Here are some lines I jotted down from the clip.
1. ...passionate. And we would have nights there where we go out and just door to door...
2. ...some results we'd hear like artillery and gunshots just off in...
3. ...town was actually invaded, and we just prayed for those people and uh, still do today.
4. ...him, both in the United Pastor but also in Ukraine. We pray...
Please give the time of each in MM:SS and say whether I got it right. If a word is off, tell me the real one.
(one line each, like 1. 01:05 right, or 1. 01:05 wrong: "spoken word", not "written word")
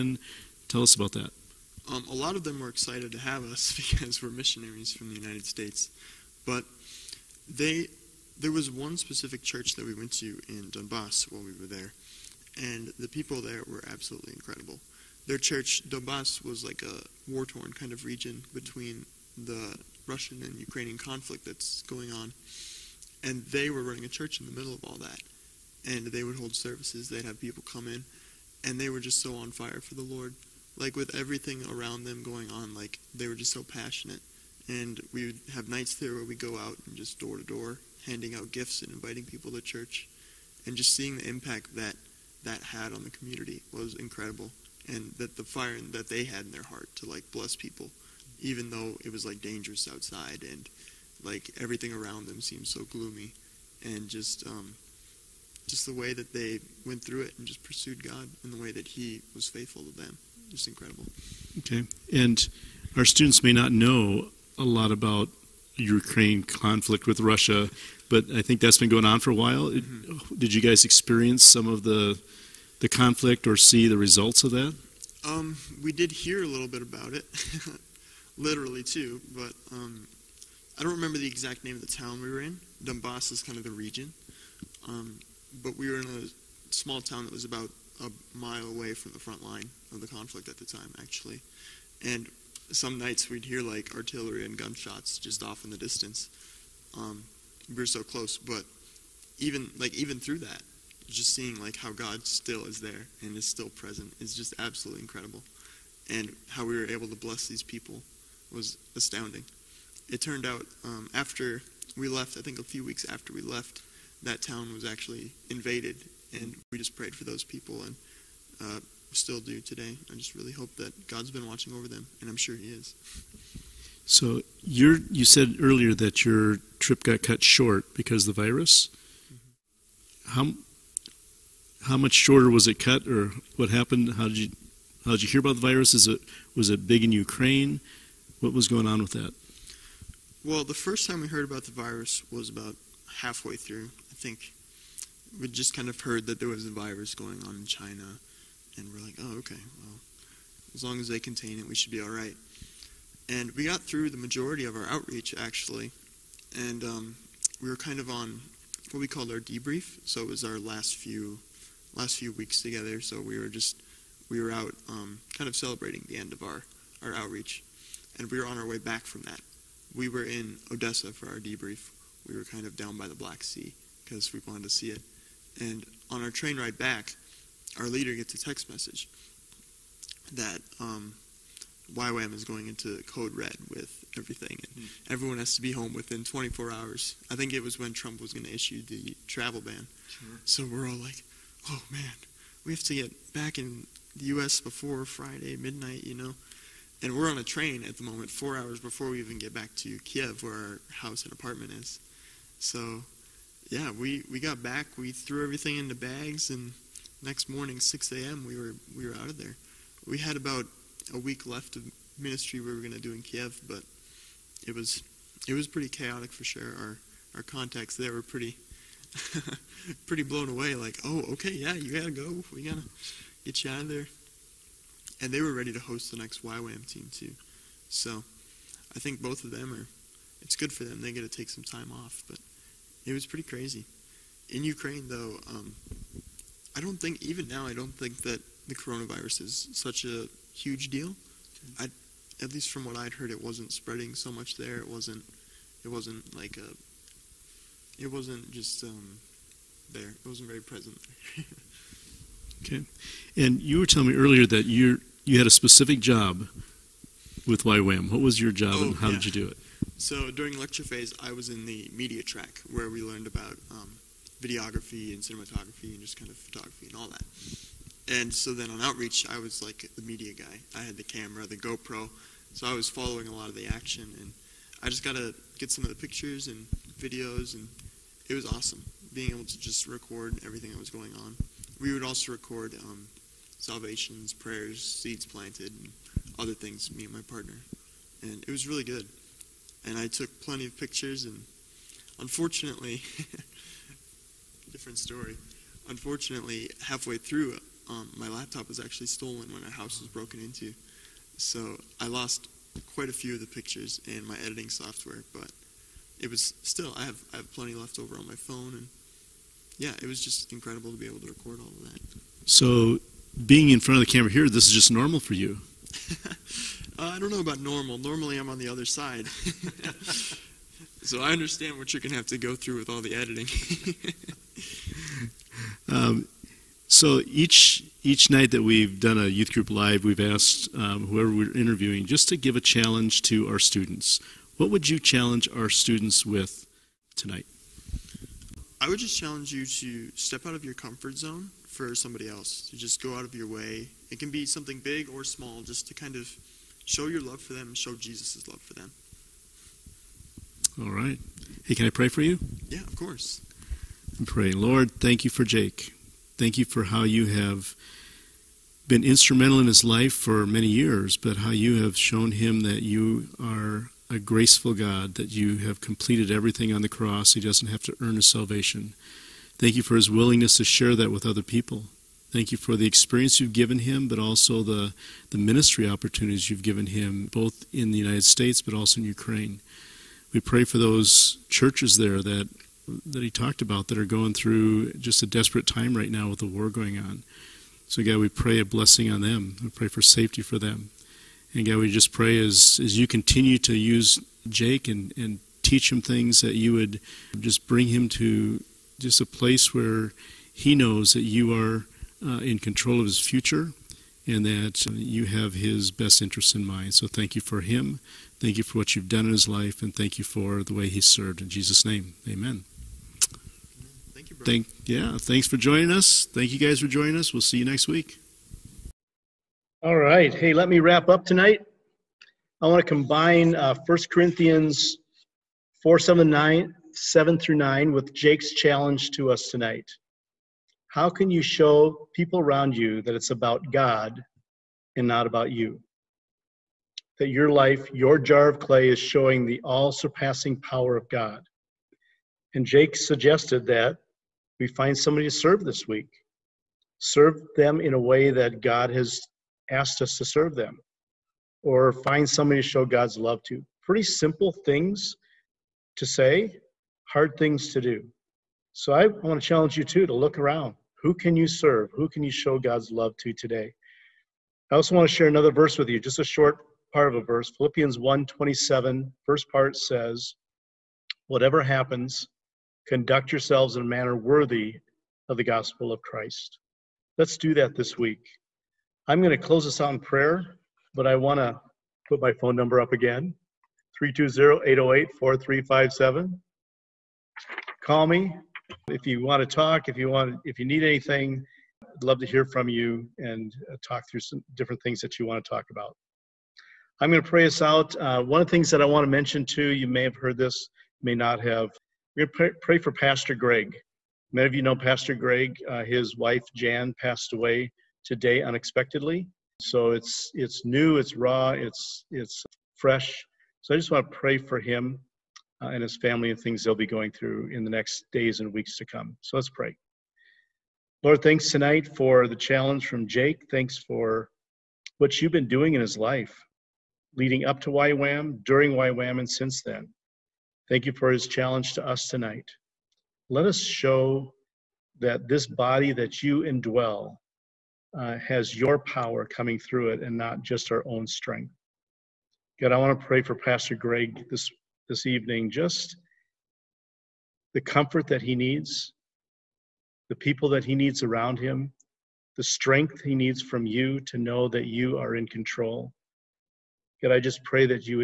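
1. 00:33 right
2. 01:32 wrong: "nights", not "results"
3. 01:54 right
4. 06:16 wrong: "States", not "Pastor".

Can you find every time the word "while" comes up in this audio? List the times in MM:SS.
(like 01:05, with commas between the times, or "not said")
00:11, 01:09.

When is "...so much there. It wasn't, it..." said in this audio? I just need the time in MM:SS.
04:04.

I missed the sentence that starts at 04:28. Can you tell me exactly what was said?
And so then on outreach, I was like the media guy.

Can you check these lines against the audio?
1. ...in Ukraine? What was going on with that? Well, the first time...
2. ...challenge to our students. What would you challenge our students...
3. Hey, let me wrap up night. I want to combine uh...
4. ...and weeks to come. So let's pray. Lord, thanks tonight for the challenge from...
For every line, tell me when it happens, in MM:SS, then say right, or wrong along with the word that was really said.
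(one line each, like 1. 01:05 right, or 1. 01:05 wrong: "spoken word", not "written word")
1. 02:17 right
2. 05:32 right
3. 07:00 wrong: "tonight", not "night"
4. 08:38 right.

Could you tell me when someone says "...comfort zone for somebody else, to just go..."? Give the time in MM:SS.
05:40.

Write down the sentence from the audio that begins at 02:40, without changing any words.
So it was our last few last few weeks together.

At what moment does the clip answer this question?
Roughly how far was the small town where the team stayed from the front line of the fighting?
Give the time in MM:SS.
01:27.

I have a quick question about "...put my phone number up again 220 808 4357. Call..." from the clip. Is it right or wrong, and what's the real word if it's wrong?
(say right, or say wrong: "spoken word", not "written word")
wrong: "320", not "220".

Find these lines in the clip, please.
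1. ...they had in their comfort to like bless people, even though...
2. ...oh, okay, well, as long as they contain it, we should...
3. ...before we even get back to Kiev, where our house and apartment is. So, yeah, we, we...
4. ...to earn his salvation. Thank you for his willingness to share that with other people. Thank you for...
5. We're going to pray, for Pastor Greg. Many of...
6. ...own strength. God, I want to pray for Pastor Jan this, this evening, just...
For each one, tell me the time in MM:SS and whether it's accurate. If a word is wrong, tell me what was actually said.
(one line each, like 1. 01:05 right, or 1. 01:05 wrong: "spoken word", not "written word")
1. 00:46 wrong: "heart", not "comfort"
2. 02:29 right
3. 03:18 right
4. 06:07 right
5. 08:22 right
6. 09:00 wrong: "Greg", not "Jan".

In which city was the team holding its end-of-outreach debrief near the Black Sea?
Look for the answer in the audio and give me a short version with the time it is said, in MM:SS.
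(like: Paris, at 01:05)
Odessa, at 02:50.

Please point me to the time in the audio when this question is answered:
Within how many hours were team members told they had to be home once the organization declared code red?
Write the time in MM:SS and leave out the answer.
03:06.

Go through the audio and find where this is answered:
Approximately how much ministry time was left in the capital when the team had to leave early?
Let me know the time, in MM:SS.
03:30.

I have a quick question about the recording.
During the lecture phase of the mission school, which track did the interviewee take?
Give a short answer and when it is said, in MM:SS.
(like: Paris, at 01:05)
media track, at 04:21.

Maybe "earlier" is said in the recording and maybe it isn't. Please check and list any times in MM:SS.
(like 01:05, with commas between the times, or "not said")
02:05, 04:14.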